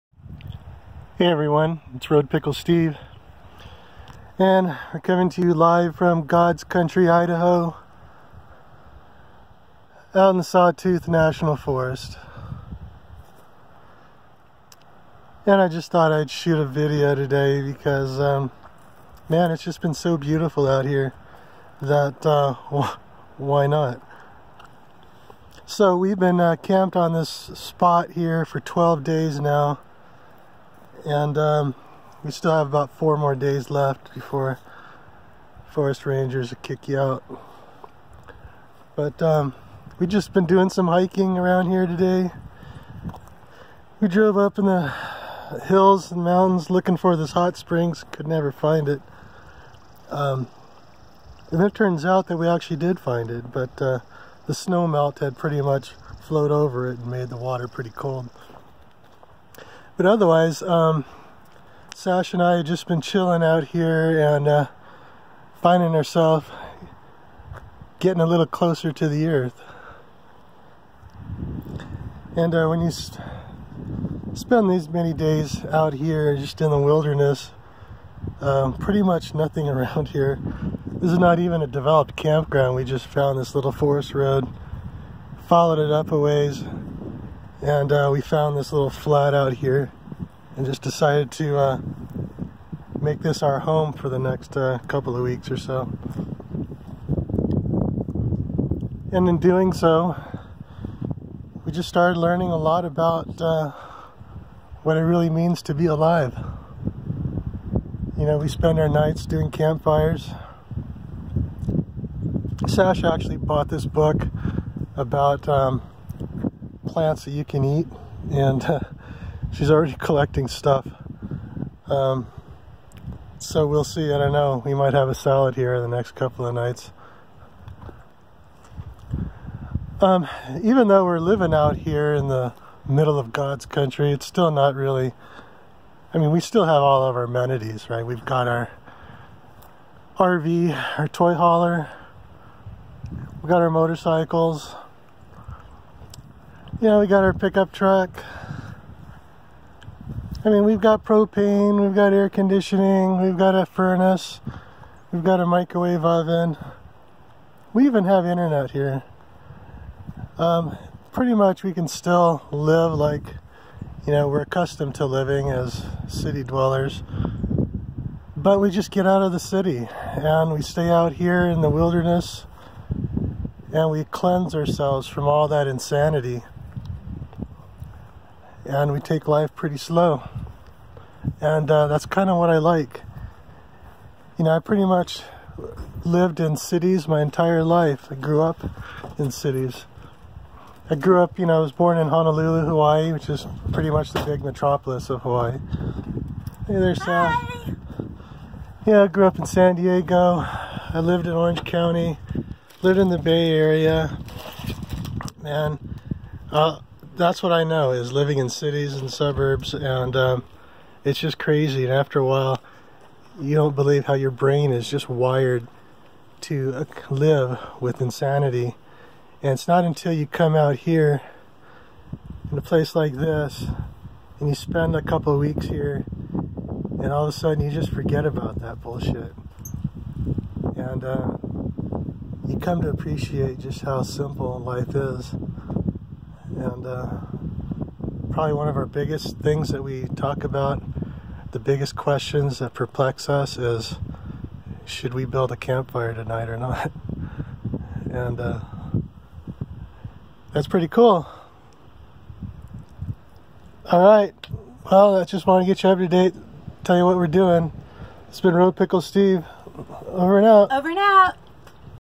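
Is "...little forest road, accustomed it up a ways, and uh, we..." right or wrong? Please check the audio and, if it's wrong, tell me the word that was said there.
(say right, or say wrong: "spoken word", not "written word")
wrong: "followed", not "accustomed".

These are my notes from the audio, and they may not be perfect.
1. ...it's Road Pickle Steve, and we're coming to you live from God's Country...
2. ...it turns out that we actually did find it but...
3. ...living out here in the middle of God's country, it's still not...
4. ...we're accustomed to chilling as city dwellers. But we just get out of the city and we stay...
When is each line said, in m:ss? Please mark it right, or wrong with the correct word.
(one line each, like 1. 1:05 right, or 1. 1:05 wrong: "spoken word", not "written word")
1. 0:01 right
2. 0:51 right
3. 2:11 right
4. 2:44 wrong: "living", not "chilling".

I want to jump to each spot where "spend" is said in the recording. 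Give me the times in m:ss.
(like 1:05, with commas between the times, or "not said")
1:12, 1:48, 3:44.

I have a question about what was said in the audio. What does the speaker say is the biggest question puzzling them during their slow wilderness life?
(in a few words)
Build a campfire.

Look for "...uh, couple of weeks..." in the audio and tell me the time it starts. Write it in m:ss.
1:34.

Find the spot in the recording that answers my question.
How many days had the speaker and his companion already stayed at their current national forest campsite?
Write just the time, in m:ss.
0:28.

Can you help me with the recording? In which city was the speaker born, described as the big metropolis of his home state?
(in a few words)
Honolulu.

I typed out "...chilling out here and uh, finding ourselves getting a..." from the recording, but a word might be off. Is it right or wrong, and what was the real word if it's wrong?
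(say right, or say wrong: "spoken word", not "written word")
right.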